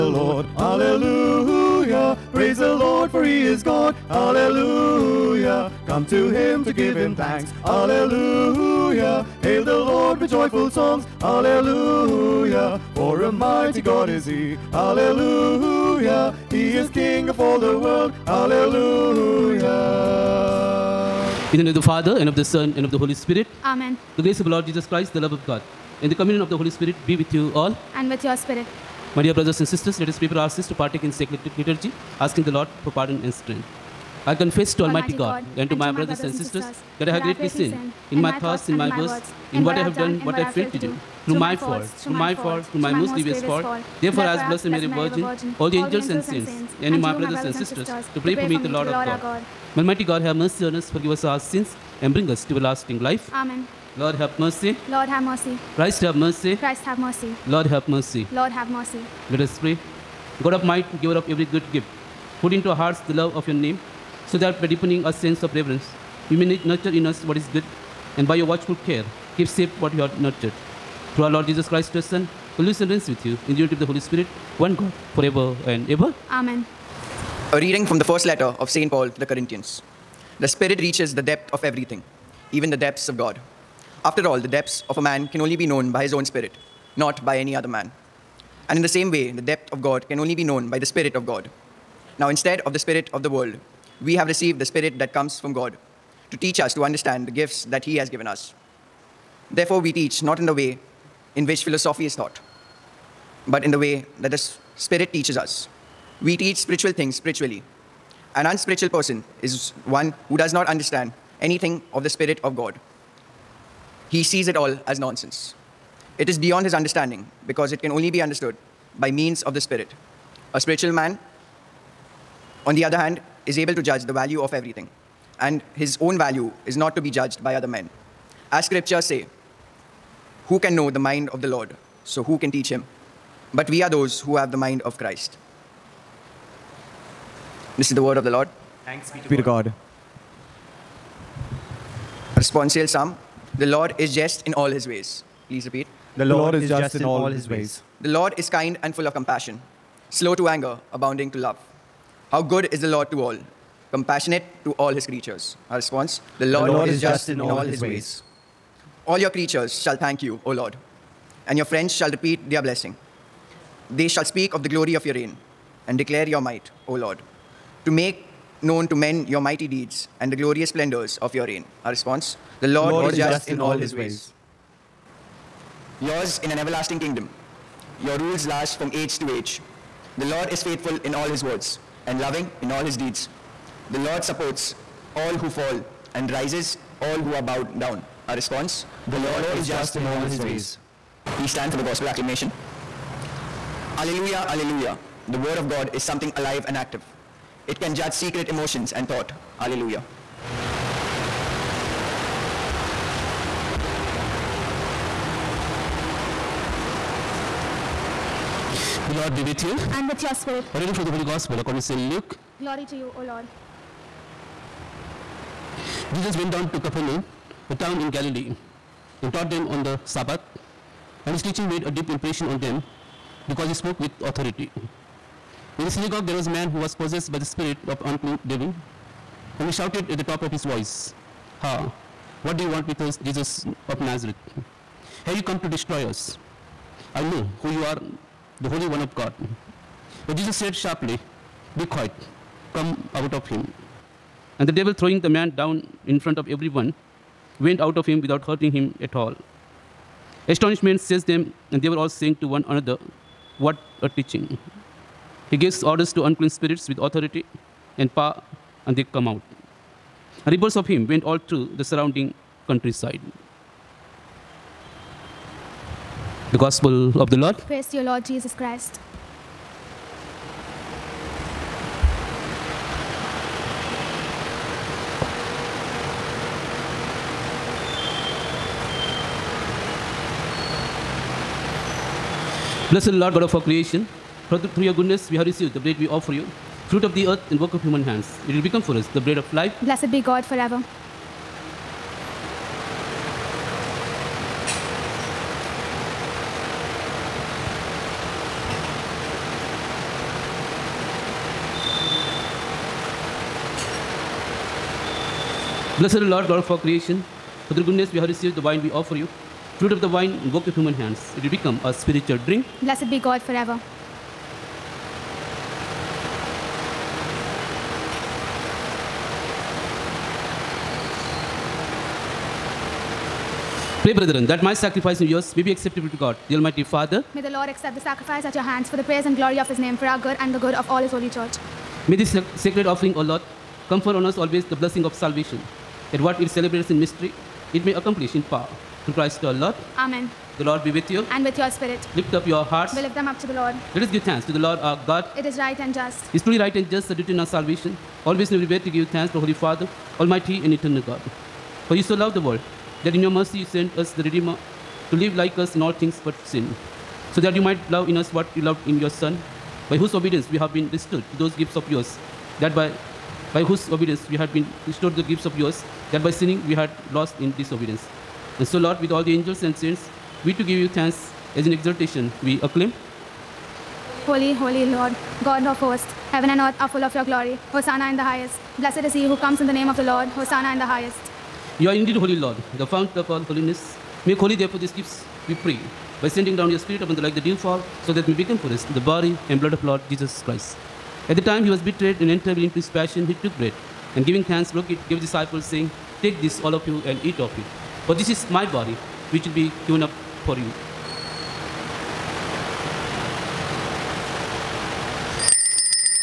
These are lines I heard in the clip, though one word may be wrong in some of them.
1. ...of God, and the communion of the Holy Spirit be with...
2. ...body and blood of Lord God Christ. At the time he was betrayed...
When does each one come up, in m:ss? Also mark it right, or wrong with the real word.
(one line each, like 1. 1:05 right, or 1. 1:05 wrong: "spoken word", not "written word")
1. 0:25 right
2. 6:28 wrong: "Jesus", not "God".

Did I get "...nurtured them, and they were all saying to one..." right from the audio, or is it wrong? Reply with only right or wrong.
wrong.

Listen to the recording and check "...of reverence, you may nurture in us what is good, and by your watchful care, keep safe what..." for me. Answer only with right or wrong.
right.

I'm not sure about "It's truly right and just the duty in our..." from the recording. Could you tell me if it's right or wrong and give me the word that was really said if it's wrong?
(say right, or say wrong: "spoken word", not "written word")
right.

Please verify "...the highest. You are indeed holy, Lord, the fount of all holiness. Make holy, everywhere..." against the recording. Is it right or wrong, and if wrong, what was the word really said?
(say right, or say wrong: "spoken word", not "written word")
wrong: "therefore", not "everywhere".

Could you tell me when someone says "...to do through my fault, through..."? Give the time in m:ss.
0:40.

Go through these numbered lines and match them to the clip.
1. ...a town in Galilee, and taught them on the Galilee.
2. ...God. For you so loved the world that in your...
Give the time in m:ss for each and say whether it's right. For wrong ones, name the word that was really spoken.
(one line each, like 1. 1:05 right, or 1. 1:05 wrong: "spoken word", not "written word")
1. 3:37 wrong: "Sabbath", not "Galilee"
2. 5:51 right.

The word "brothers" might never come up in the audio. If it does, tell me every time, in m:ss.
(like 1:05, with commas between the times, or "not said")
0:29, 0:35, 0:47.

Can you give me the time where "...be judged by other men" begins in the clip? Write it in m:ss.
2:07.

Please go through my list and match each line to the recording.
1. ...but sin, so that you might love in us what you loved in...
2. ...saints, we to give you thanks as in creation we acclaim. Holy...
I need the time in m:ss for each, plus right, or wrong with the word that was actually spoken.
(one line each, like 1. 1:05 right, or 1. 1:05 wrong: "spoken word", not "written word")
1. 5:56 right
2. 6:09 wrong: "exaltation", not "creation".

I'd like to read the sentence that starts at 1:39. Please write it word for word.
Therefore, we teach not in the way in which philosophy is taught, but in the way that the Spirit teaches us.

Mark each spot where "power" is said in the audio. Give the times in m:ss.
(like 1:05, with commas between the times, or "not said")
4:18, 5:38.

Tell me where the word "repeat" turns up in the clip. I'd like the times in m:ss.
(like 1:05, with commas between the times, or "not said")
2:25, 2:42.